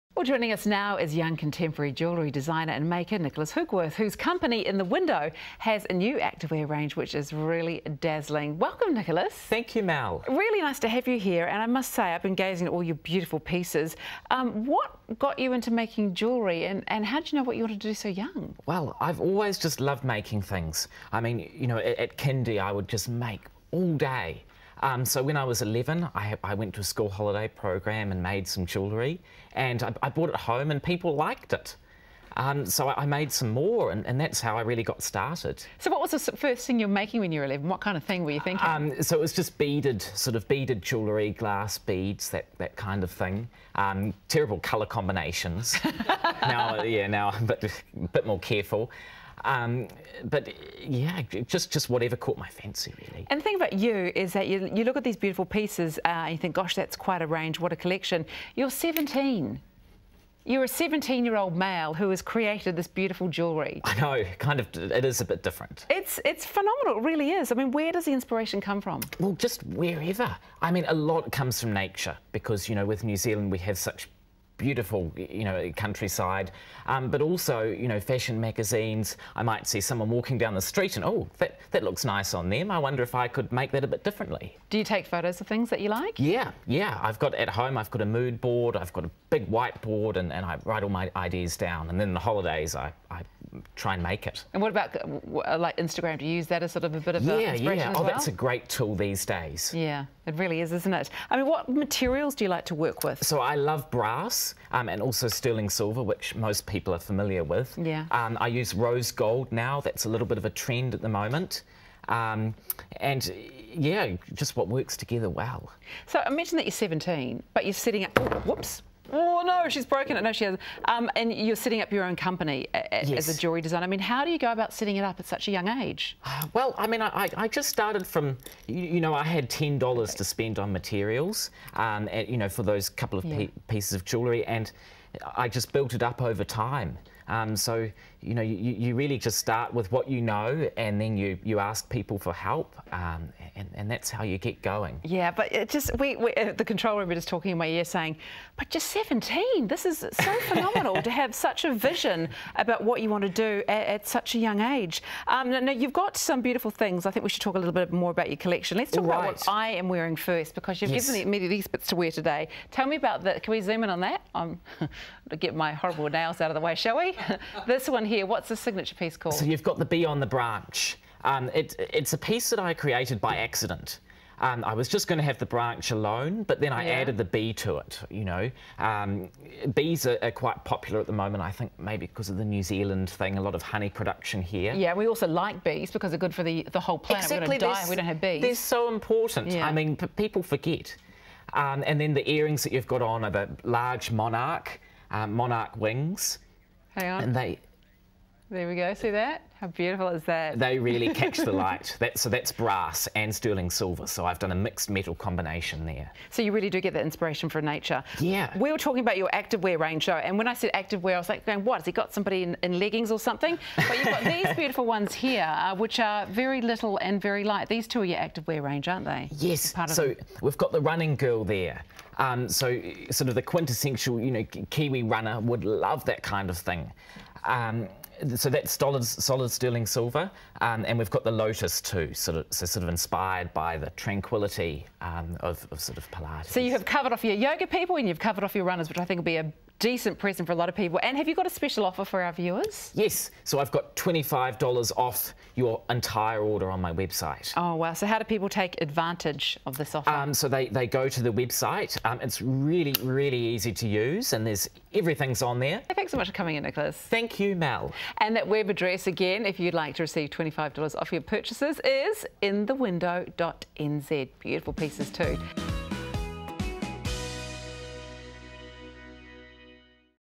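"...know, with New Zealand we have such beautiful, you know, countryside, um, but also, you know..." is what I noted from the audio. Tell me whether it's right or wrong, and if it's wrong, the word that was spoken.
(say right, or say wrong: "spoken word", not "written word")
right.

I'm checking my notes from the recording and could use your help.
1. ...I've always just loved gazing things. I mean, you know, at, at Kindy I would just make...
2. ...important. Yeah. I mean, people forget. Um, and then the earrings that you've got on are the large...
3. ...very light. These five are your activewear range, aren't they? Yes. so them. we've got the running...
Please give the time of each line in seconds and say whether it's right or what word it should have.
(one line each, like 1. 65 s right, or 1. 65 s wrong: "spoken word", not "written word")
1. 19 s wrong: "making", not "gazing"
2. 188 s right
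3. 217 s wrong: "two", not "five".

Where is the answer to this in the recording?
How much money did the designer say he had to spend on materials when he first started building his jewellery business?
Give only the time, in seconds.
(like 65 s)
129 s.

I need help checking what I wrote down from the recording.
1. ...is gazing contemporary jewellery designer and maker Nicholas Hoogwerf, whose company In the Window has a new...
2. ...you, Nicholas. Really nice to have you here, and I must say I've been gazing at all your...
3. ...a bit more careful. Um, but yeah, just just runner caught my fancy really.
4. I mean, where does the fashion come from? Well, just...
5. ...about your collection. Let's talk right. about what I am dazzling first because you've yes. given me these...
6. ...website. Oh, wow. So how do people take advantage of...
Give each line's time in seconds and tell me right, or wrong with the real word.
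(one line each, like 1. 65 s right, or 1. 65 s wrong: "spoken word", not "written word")
1. 0 s wrong: "young", not "gazing"
2. 9 s wrong: "Mal", not "Nicholas"
3. 48 s wrong: "whatever", not "runner"
4. 67 s wrong: "inspiration", not "fashion"
5. 158 s wrong: "wearing", not "dazzling"
6. 246 s right.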